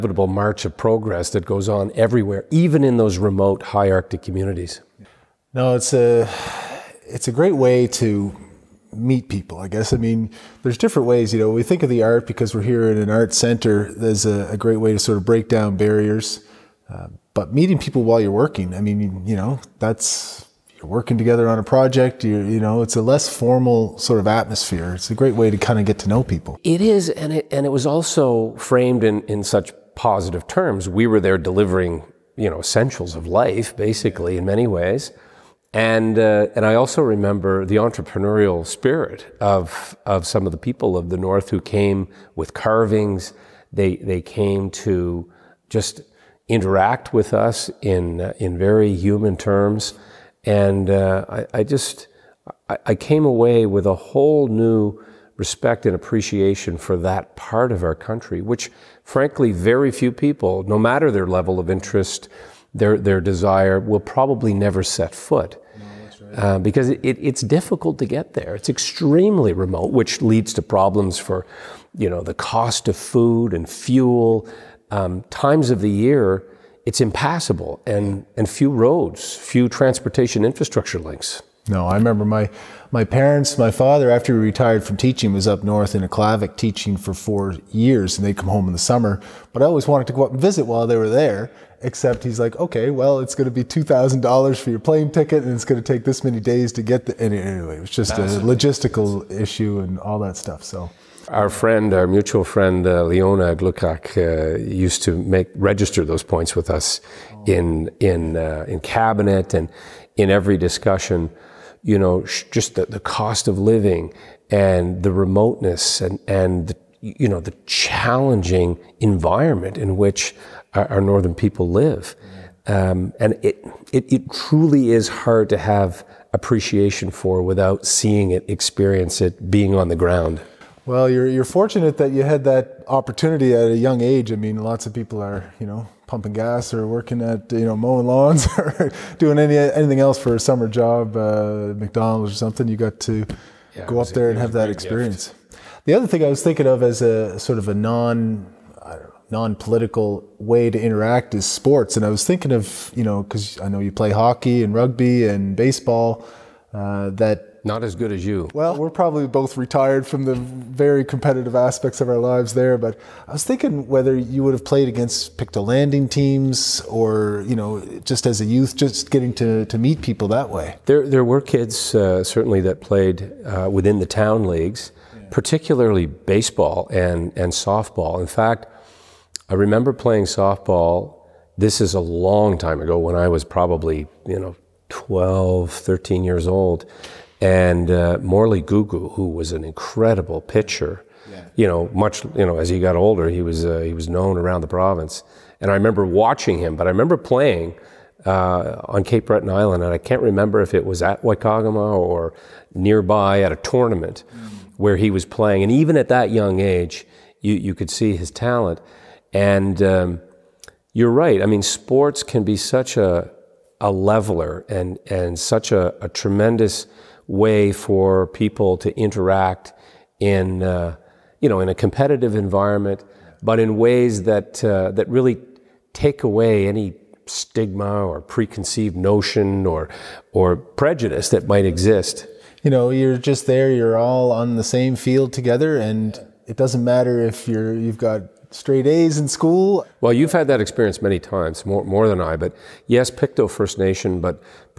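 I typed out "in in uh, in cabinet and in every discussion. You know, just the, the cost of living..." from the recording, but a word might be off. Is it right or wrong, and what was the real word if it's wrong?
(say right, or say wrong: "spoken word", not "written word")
right.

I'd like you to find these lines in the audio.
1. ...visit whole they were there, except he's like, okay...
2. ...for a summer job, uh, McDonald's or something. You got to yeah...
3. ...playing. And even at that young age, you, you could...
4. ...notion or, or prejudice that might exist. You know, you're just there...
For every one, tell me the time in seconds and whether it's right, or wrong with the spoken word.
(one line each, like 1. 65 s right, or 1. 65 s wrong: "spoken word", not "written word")
1. 90 s wrong: "while", not "whole"
2. 140 s right
3. 205 s right
4. 228 s right.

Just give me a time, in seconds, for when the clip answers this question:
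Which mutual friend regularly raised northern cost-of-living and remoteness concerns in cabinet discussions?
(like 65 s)
103 s.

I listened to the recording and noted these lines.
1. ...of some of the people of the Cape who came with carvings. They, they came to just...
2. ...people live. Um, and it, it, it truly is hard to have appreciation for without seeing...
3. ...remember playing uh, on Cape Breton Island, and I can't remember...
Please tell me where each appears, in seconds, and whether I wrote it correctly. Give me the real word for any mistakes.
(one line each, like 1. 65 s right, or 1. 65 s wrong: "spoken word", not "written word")
1. 40 s wrong: "North", not "Cape"
2. 121 s right
3. 196 s right.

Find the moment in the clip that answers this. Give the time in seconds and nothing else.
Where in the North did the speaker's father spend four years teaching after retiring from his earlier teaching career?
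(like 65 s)
86 s.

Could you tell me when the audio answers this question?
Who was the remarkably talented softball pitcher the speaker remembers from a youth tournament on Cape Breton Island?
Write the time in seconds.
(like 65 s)
188 s.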